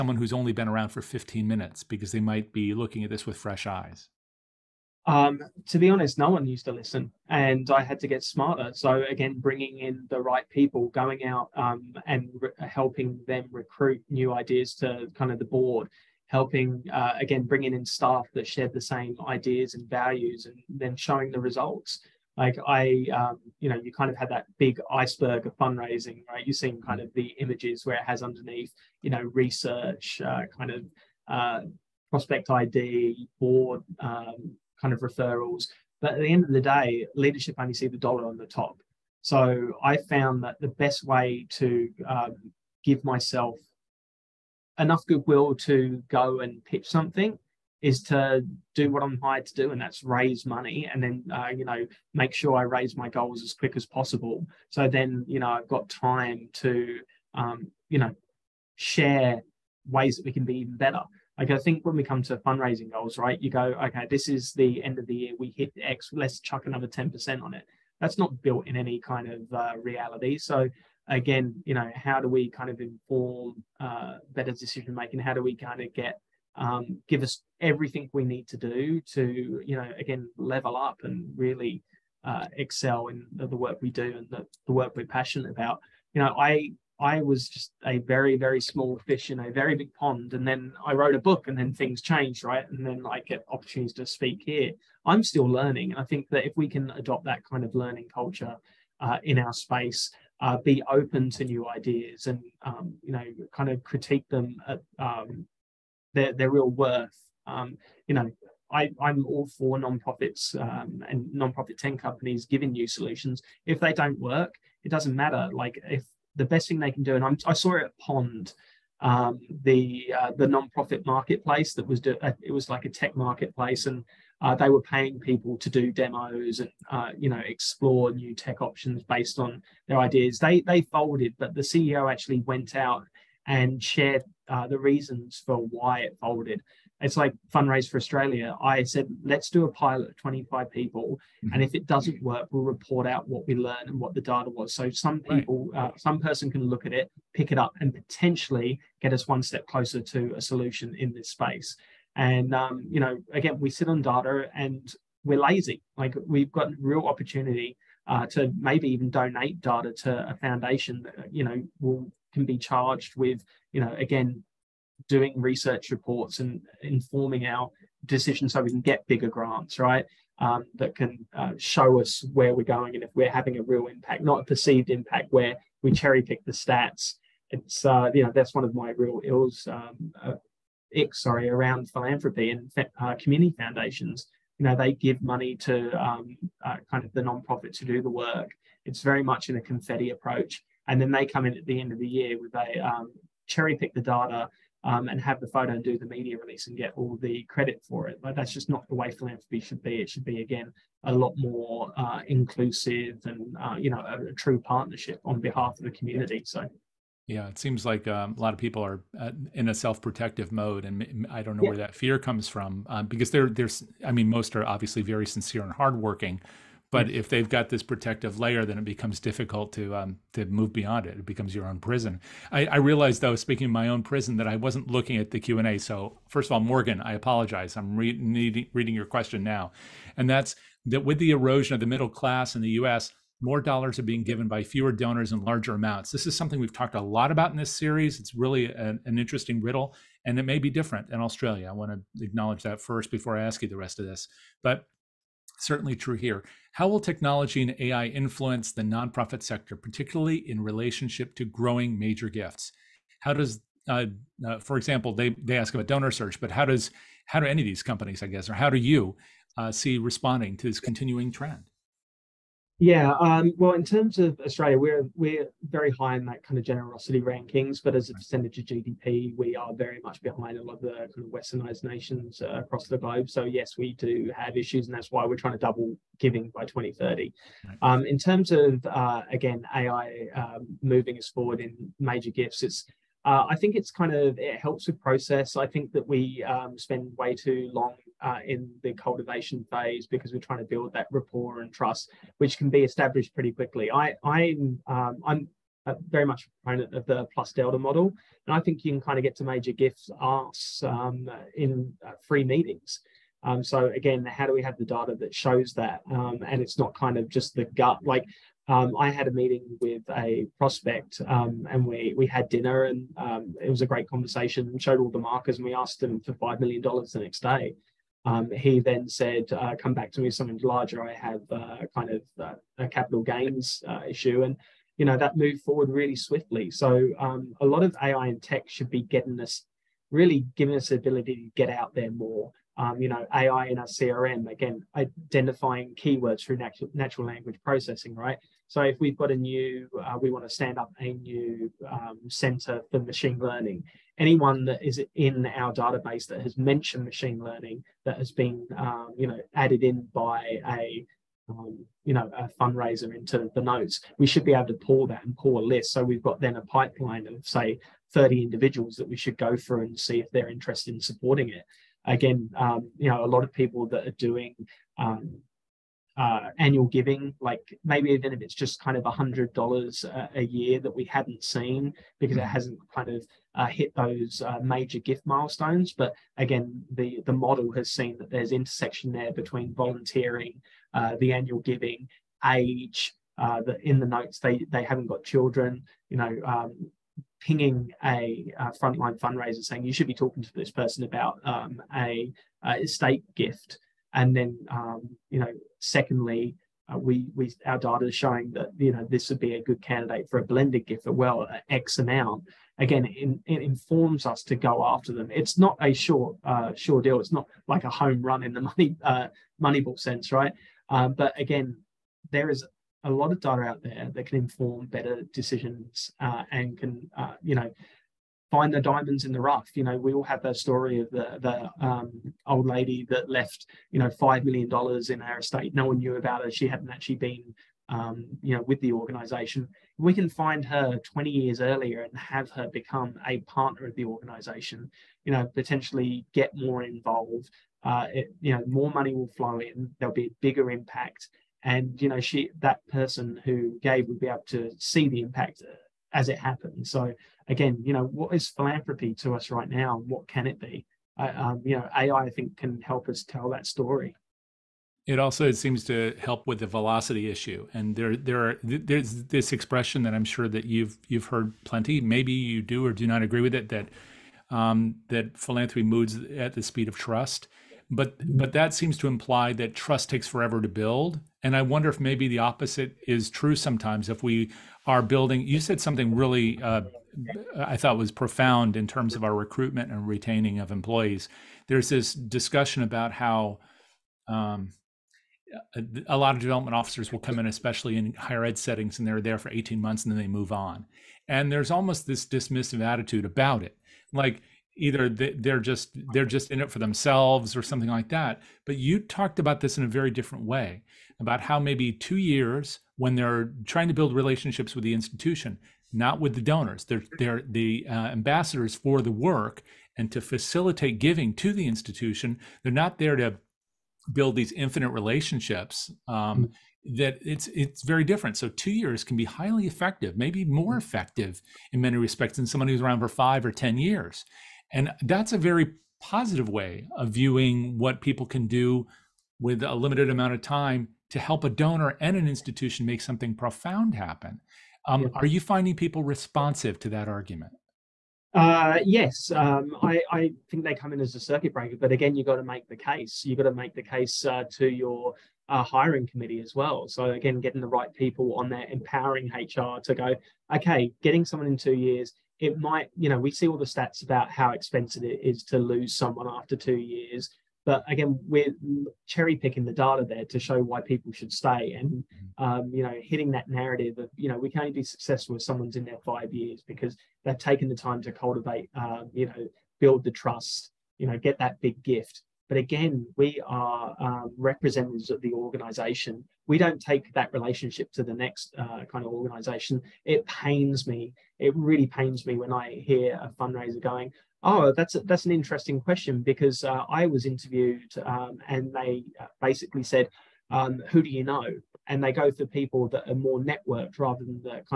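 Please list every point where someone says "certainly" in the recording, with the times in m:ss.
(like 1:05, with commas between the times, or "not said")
4:05.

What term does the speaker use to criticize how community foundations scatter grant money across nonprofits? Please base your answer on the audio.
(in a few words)
Confetti approach.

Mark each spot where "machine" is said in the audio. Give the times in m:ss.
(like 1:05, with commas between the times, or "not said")
5:43, 5:47.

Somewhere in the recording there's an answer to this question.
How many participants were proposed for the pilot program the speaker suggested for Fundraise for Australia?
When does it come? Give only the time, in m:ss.
2:20.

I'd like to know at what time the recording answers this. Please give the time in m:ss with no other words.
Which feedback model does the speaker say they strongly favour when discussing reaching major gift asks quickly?
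4:57.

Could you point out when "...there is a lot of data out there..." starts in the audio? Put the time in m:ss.
6:52.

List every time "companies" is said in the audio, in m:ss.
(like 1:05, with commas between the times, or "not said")
1:51, 4:17.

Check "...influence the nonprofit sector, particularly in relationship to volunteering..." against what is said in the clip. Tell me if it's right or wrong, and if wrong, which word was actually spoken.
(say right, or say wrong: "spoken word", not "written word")
wrong: "growing", not "volunteering".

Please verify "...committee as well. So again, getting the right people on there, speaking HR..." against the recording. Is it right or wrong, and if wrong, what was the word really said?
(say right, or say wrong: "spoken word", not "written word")
wrong: "empowering", not "speaking".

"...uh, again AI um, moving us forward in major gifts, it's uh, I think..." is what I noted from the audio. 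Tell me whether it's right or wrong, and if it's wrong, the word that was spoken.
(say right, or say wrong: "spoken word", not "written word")
right.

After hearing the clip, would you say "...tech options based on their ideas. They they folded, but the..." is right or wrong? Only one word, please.
right.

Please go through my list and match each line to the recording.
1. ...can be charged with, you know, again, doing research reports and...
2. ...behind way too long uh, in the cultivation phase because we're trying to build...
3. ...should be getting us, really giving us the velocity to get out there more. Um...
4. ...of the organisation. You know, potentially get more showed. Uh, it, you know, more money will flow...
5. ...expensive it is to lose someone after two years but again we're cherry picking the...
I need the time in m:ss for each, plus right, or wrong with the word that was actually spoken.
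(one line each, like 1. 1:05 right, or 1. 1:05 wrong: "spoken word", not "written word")
1. 2:42 right
2. 4:46 wrong: "spend", not "behind"
3. 5:28 wrong: "ability", not "velocity"
4. 7:13 wrong: "involved", not "showed"
5. 9:14 right.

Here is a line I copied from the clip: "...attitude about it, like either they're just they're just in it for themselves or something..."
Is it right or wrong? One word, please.
right.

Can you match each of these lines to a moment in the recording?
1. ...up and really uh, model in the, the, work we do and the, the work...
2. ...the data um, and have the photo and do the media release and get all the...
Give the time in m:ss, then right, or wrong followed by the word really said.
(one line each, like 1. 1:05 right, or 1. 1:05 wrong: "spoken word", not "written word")
1. 1:20 wrong: "excel", not "model"
2. 3:13 right.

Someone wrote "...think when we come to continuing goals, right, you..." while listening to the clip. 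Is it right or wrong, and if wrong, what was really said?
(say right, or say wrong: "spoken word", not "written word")
wrong: "fundraising", not "continuing".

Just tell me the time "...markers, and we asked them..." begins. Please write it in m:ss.
5:15.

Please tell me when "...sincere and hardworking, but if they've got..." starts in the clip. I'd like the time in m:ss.
3:35.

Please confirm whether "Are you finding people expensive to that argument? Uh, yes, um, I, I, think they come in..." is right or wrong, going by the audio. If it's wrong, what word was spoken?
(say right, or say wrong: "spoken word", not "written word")
wrong: "responsive", not "expensive".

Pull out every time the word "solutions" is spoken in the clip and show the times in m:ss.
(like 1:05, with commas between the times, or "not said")
1:52, 2:30.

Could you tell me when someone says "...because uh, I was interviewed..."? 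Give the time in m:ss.
9:46.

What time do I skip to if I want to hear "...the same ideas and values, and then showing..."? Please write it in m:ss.
0:18.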